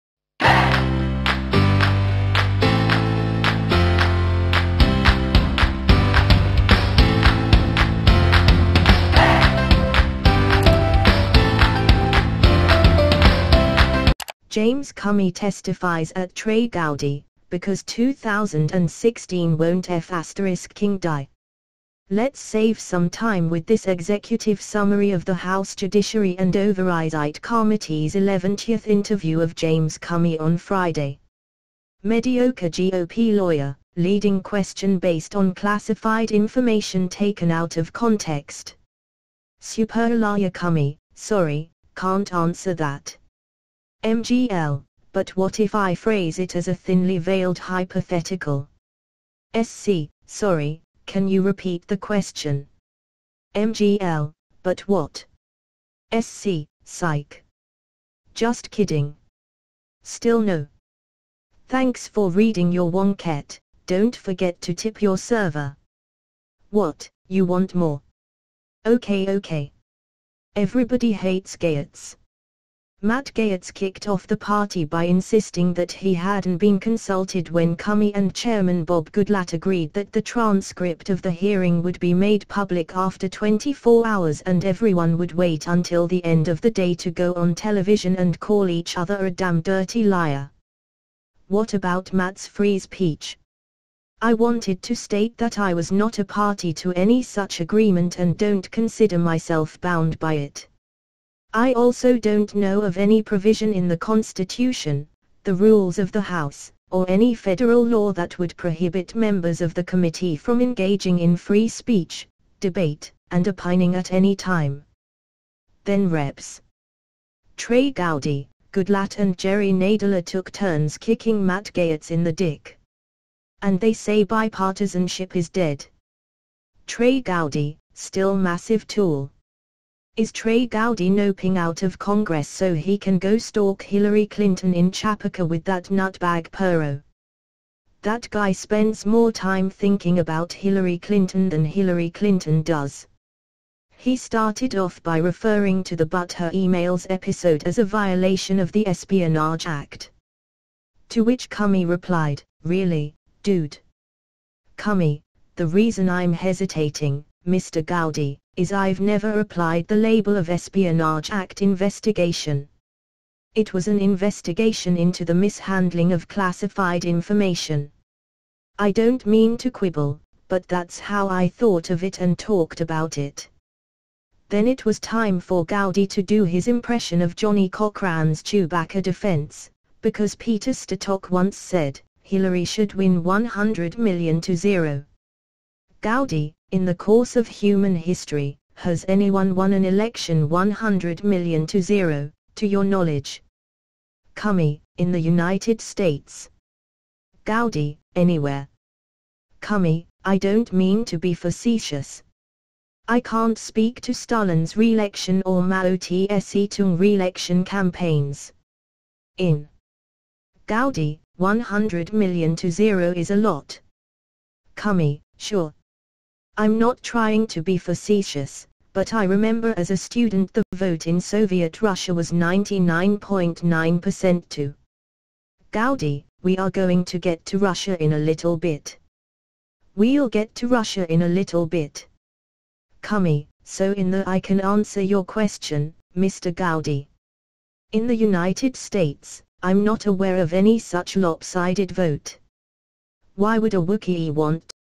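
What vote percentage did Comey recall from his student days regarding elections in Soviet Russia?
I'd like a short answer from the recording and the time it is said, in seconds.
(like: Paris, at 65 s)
99.9%, at 222 s.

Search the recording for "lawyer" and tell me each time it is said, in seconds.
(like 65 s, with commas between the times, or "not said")
33 s, 40 s.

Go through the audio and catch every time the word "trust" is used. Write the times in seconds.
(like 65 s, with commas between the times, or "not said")
not said.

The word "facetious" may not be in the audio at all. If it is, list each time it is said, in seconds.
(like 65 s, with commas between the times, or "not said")
201 s, 217 s.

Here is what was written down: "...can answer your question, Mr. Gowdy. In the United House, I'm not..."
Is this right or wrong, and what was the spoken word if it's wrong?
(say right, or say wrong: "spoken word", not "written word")
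wrong: "States", not "House".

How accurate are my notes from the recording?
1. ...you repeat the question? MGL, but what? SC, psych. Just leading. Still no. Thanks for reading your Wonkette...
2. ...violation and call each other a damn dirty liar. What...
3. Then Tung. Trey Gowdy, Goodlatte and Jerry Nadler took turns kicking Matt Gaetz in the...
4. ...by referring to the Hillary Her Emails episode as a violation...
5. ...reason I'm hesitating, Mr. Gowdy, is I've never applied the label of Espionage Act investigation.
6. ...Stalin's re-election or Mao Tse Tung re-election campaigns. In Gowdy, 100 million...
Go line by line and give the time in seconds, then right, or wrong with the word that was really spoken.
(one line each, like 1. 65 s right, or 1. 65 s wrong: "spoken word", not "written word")
1. 51 s wrong: "kidding", not "leading"
2. 87 s wrong: "television", not "violation"
3. 115 s wrong: "Reps", not "Tung"
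4. 145 s wrong: "But", not "Hillary"
5. 155 s right
6. 204 s right.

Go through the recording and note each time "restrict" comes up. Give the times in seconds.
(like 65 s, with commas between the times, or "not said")
not said.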